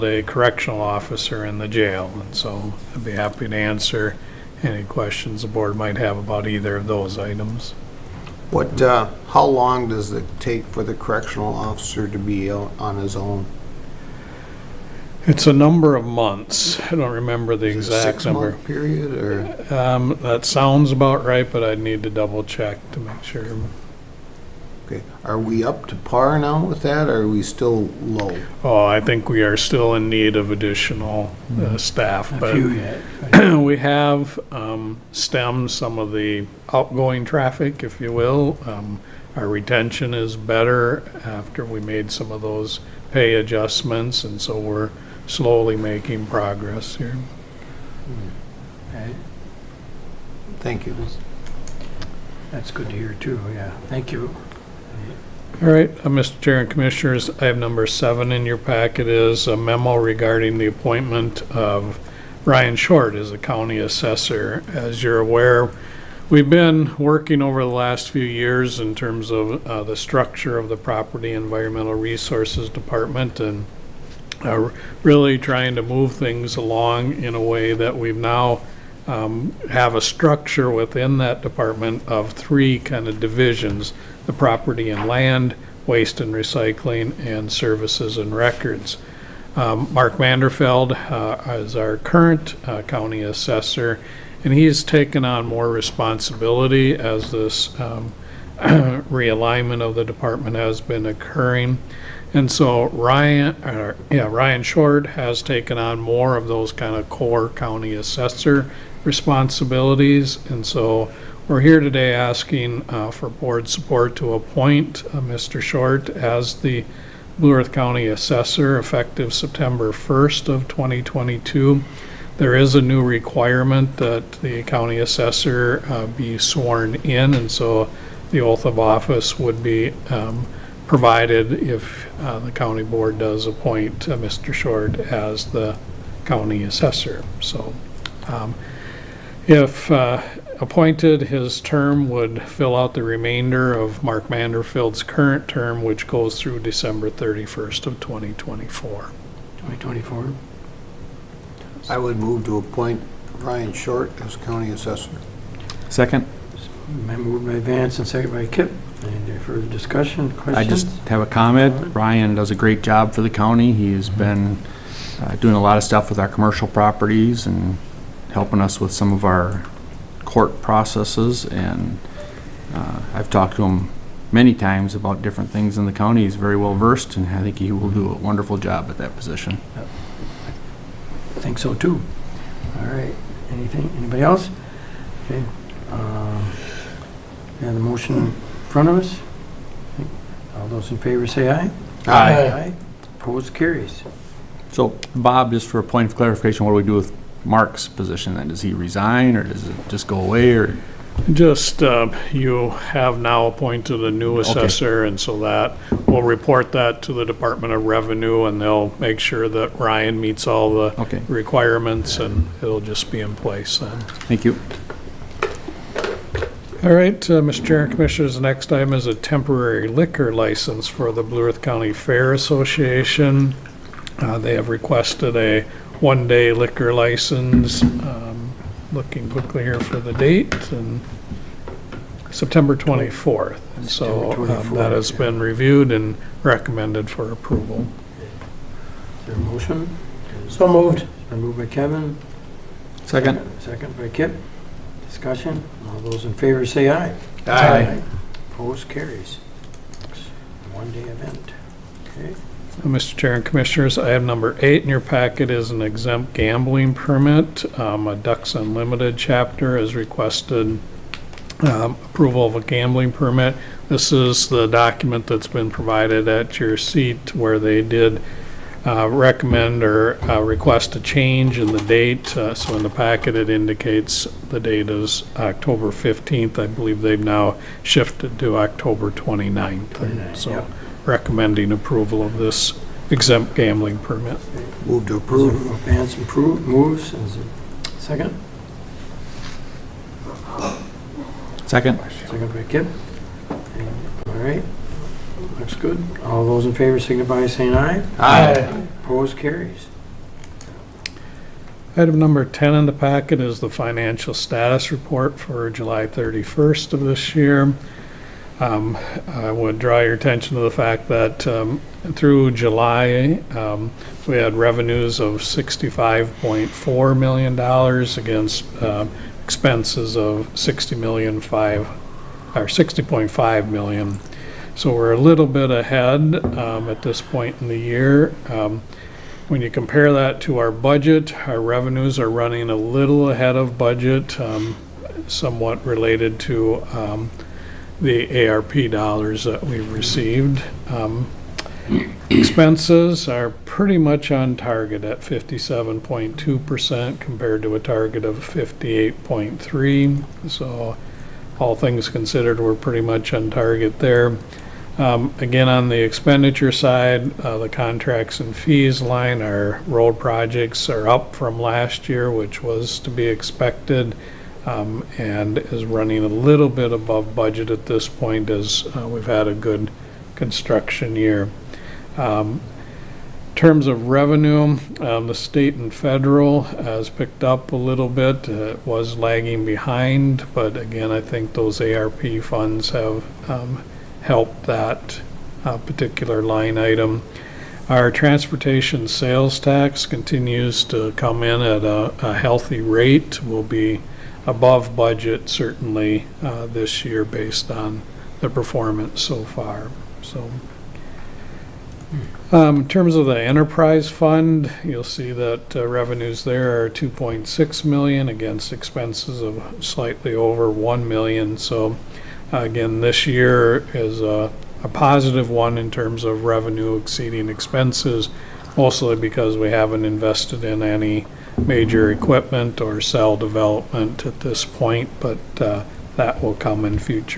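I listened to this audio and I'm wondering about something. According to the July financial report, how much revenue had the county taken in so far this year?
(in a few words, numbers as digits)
$65.4 million.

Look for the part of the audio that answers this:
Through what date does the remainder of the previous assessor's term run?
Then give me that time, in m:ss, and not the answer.
2:26.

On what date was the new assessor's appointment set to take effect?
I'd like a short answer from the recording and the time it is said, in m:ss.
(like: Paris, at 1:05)
September 1st, 2022, at 1:59.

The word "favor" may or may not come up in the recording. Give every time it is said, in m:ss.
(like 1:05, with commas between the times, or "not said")
3:10, 4:06, 4:56.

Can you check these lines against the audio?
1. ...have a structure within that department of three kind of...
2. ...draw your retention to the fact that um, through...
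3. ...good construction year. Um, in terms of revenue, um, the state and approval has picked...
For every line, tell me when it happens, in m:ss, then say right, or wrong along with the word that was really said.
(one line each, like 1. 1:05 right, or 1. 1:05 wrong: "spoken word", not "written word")
1. 1:19 right
2. 5:09 wrong: "attention", not "retention"
3. 6:09 wrong: "federal", not "approval".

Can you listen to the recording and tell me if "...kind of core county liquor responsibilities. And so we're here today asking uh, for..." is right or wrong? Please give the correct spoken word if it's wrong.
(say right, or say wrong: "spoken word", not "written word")
wrong: "assessor", not "liquor".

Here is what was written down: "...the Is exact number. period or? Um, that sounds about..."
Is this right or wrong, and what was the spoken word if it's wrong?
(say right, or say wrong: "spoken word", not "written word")
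right.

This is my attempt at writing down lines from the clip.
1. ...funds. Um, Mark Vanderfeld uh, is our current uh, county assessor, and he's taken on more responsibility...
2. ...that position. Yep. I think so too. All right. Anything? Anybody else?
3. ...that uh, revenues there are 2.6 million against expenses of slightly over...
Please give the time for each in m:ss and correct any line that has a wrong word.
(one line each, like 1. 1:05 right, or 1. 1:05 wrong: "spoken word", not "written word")
1. 1:28 wrong: "records", not "funds"
2. 2:58 right
3. 6:45 right.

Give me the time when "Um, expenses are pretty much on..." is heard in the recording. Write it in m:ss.
5:40.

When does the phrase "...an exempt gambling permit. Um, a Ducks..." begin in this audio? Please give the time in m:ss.
4:15.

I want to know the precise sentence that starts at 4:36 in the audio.
I believe they've now shifted to October 29th.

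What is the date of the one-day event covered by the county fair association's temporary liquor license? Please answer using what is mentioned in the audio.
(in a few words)
September 24th.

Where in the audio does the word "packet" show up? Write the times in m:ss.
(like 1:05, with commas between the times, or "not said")
0:58, 4:14, 4:32, 5:02.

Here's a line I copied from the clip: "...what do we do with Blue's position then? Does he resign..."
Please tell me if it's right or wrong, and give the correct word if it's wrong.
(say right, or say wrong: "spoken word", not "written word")
wrong: "Mark", not "Blue".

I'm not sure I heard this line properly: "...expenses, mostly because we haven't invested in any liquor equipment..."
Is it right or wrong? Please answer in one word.
wrong.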